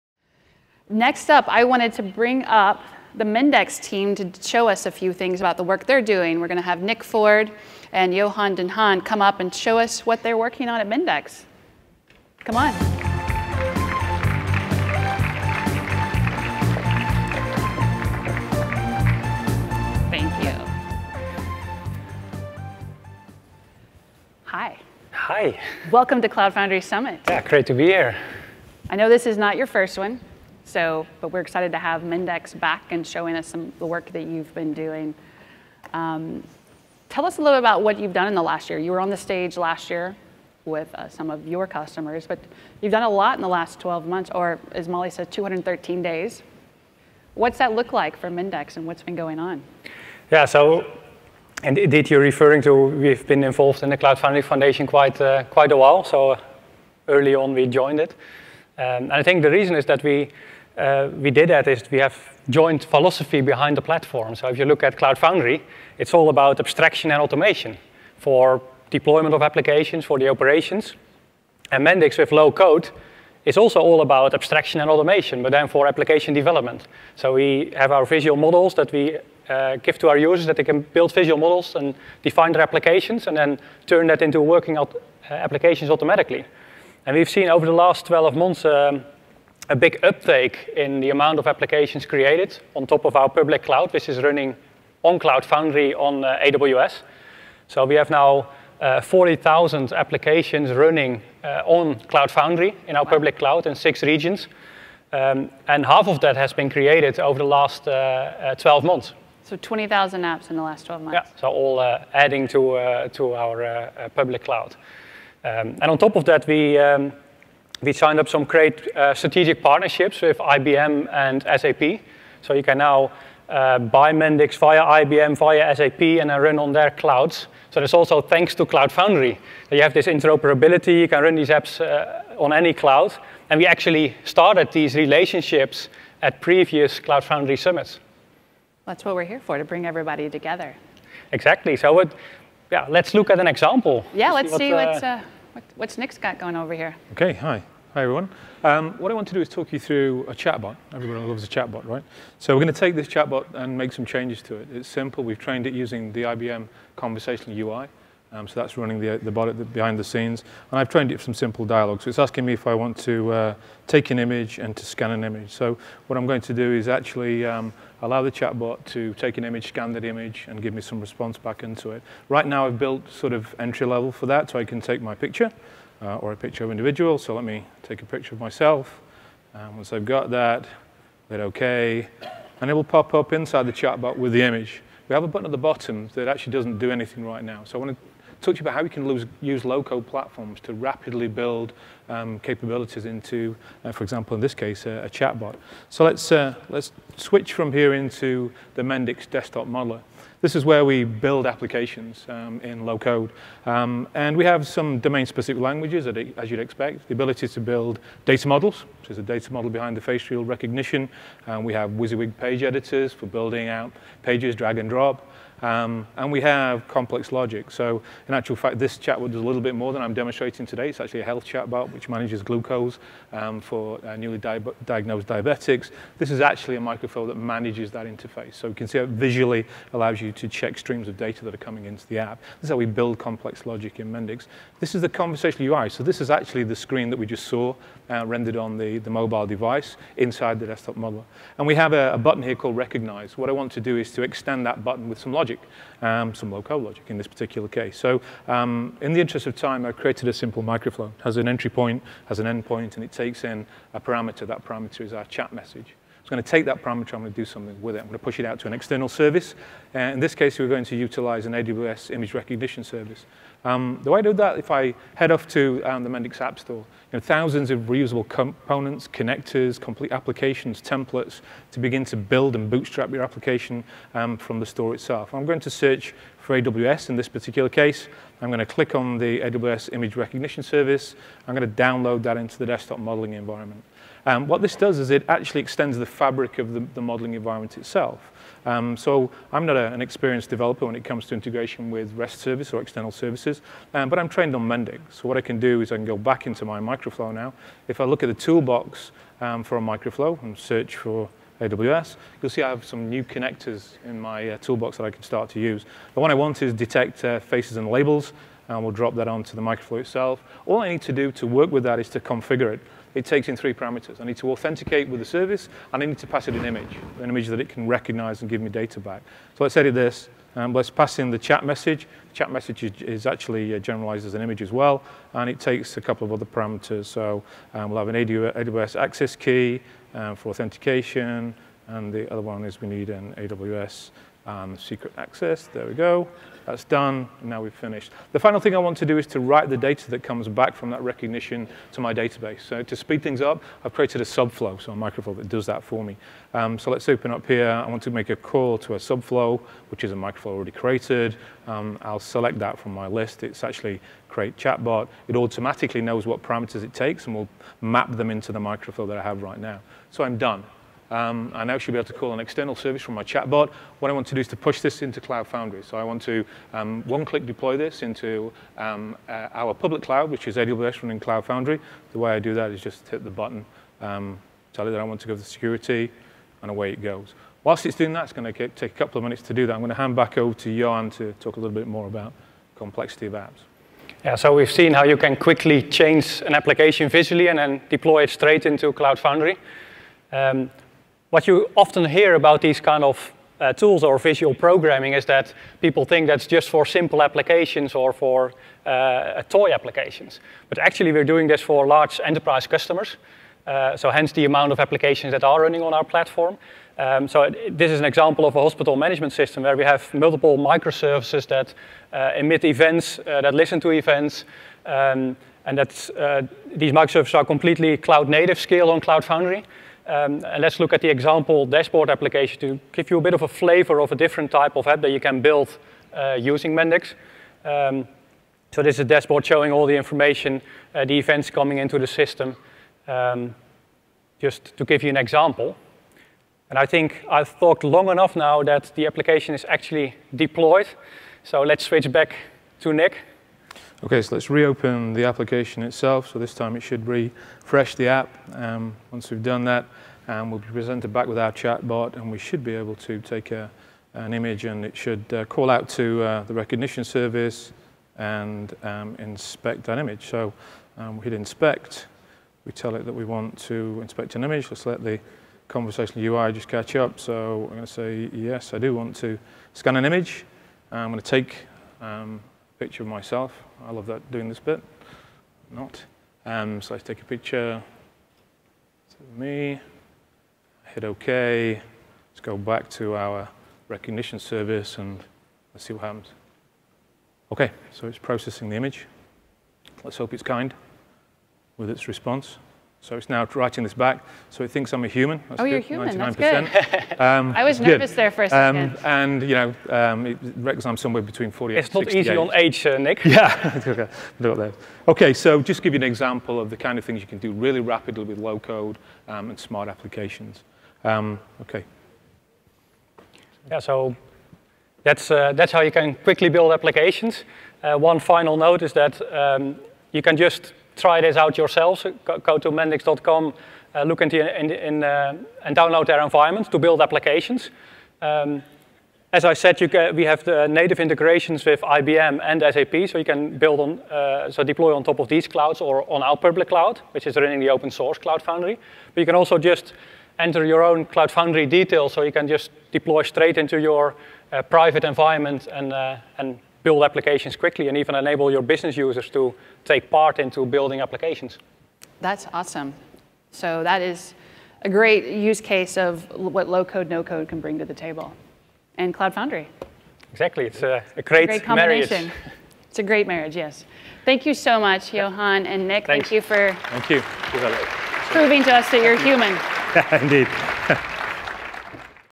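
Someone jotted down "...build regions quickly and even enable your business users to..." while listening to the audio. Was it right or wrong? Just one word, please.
wrong.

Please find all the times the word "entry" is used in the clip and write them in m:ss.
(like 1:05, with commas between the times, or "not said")
2:53, 4:11.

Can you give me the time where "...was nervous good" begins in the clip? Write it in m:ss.
8:17.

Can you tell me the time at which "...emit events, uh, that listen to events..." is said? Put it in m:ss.
6:52.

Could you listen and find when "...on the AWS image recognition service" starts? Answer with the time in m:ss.
4:38.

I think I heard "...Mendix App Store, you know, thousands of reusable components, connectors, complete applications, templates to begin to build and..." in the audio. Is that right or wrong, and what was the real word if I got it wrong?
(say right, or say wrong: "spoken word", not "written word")
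right.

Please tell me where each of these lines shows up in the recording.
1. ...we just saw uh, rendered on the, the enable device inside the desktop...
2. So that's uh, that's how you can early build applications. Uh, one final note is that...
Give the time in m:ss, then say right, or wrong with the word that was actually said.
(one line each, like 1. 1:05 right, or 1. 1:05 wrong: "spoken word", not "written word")
1. 3:57 wrong: "mobile", not "enable"
2. 8:33 wrong: "quickly", not "early".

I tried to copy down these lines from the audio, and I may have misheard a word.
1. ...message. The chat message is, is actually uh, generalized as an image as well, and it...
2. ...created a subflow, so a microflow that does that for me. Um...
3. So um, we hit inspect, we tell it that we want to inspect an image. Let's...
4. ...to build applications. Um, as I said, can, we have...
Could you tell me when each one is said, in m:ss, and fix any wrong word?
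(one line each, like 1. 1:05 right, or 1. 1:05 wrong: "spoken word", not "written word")
1. 5:21 right
2. 5:43 right
3. 7:40 right
4. 8:46 right.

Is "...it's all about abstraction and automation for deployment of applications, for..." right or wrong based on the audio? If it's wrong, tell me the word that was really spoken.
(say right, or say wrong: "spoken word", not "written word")
right.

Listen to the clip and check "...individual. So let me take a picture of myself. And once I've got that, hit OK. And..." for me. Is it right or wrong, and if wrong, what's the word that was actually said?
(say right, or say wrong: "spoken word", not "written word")
right.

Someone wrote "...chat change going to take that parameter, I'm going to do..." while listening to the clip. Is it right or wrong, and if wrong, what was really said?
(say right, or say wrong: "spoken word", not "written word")
wrong: "message", not "change".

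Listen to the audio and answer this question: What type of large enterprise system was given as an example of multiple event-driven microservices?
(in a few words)
Hospital management system.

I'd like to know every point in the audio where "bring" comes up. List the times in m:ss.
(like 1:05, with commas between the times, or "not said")
0:02, 2:19, 9:17.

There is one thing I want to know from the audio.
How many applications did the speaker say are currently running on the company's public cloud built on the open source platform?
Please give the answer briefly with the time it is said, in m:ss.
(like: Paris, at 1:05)
40,000, at 1:39.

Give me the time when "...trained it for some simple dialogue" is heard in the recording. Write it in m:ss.
2:40.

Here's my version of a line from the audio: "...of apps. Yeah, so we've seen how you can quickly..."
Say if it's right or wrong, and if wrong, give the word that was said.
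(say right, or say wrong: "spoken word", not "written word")
right.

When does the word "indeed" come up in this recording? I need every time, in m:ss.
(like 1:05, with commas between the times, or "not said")
0:51, 9:30.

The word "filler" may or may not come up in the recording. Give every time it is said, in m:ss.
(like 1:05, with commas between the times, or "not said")
not said.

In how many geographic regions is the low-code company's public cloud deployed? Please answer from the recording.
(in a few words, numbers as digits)
6.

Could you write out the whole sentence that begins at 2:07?
So that's also thanks to Cloud Foundry.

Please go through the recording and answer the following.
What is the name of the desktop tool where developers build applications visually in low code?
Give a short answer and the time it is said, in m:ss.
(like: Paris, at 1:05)
Mendix desktop modeler, at 3:18.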